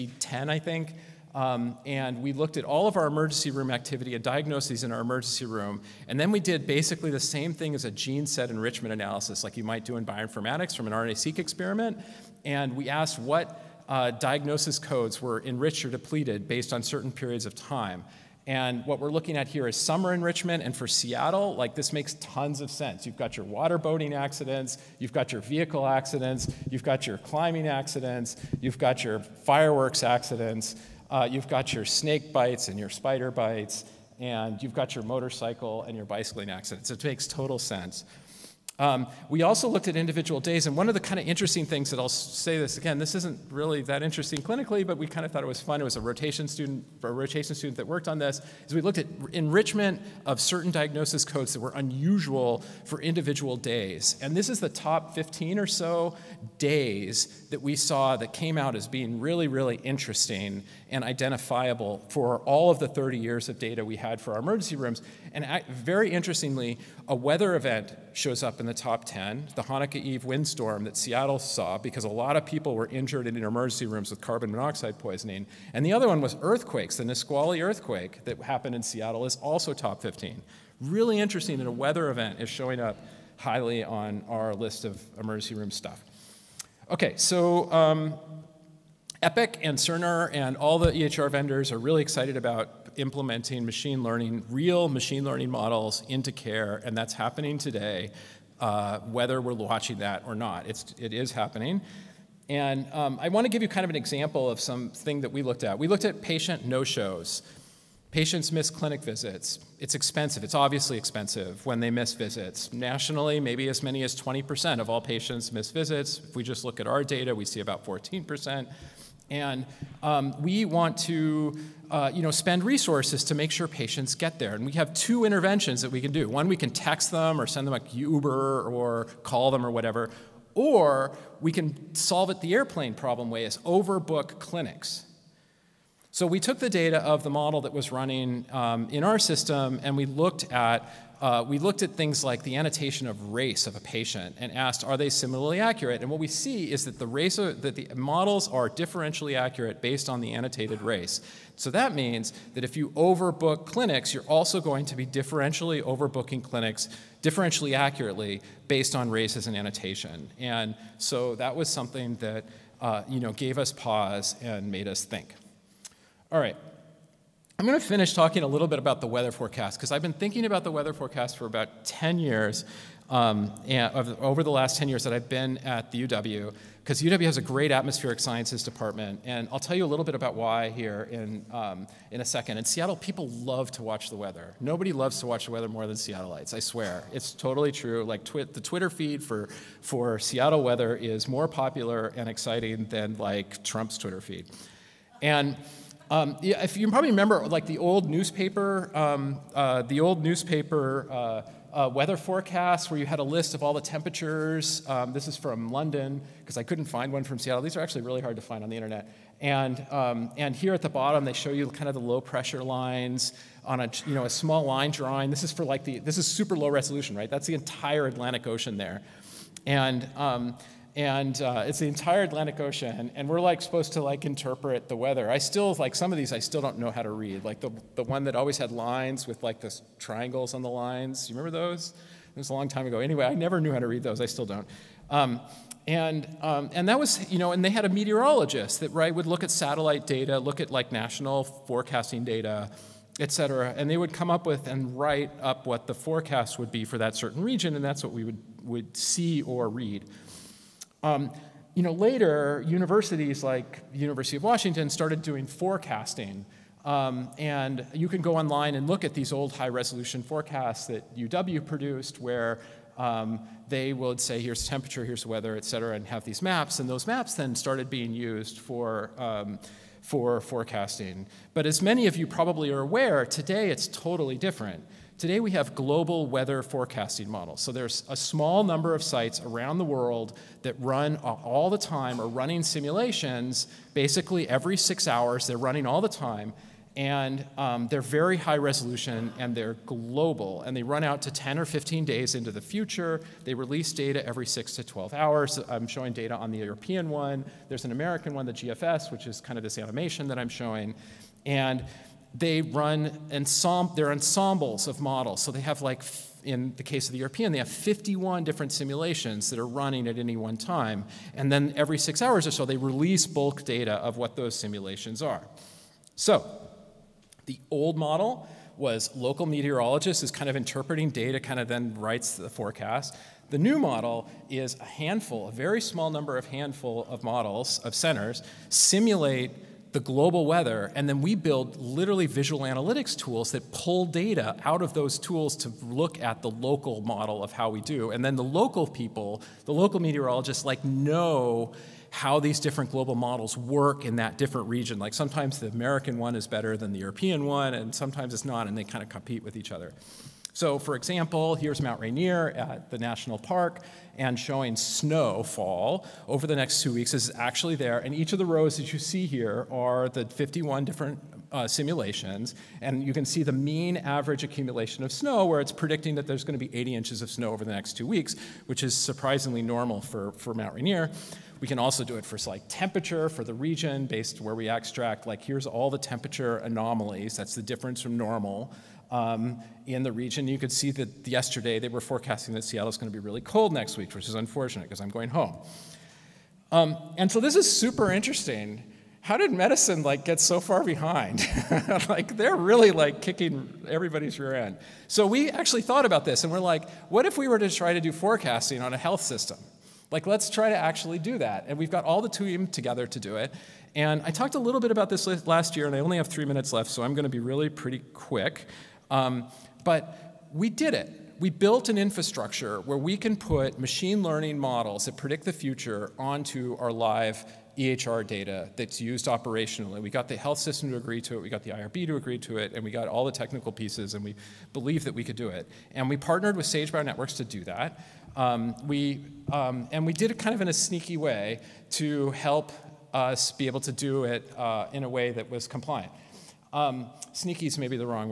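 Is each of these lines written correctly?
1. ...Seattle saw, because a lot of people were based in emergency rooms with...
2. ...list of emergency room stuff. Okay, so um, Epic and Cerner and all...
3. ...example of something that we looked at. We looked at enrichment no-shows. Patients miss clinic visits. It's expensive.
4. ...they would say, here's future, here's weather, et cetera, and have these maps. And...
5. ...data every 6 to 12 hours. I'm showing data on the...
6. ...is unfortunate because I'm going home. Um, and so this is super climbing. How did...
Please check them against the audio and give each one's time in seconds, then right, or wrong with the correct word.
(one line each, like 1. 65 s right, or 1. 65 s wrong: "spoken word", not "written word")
1. 70 s wrong: "injured", not "based"
2. 84 s right
3. 103 s wrong: "patient", not "enrichment"
4. 263 s wrong: "temperature", not "future"
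5. 293 s right
6. 384 s wrong: "interesting", not "climbing".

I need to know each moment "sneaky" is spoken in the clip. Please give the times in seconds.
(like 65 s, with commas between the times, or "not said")
430 s, 437 s.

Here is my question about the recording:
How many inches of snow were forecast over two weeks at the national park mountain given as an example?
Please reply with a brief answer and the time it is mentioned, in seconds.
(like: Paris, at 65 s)
80, at 366 s.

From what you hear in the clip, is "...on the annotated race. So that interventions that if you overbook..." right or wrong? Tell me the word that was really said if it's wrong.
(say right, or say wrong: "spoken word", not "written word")
wrong: "means", not "interventions".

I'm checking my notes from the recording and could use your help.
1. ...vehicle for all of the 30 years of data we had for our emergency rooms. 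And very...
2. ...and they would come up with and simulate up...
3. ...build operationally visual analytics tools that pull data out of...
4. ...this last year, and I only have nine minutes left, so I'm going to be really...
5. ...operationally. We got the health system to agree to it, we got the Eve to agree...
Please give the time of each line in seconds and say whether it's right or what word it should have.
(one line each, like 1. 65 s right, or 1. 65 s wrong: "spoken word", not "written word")
1. 61 s wrong: "identifiable", not "vehicle"
2. 243 s wrong: "write", not "simulate"
3. 331 s wrong: "literally", not "operationally"
4. 405 s wrong: "three", not "nine"
5. 419 s wrong: "IRB", not "Eve".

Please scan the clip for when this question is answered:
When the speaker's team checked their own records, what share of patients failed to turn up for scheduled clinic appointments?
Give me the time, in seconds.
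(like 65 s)
117 s.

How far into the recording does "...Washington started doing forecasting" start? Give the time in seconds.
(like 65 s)
254 s.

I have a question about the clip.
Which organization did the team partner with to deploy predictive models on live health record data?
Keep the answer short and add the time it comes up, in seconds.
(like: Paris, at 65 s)
Sage Bionetworks, at 426 s.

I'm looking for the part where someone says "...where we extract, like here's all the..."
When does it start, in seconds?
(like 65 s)
374 s.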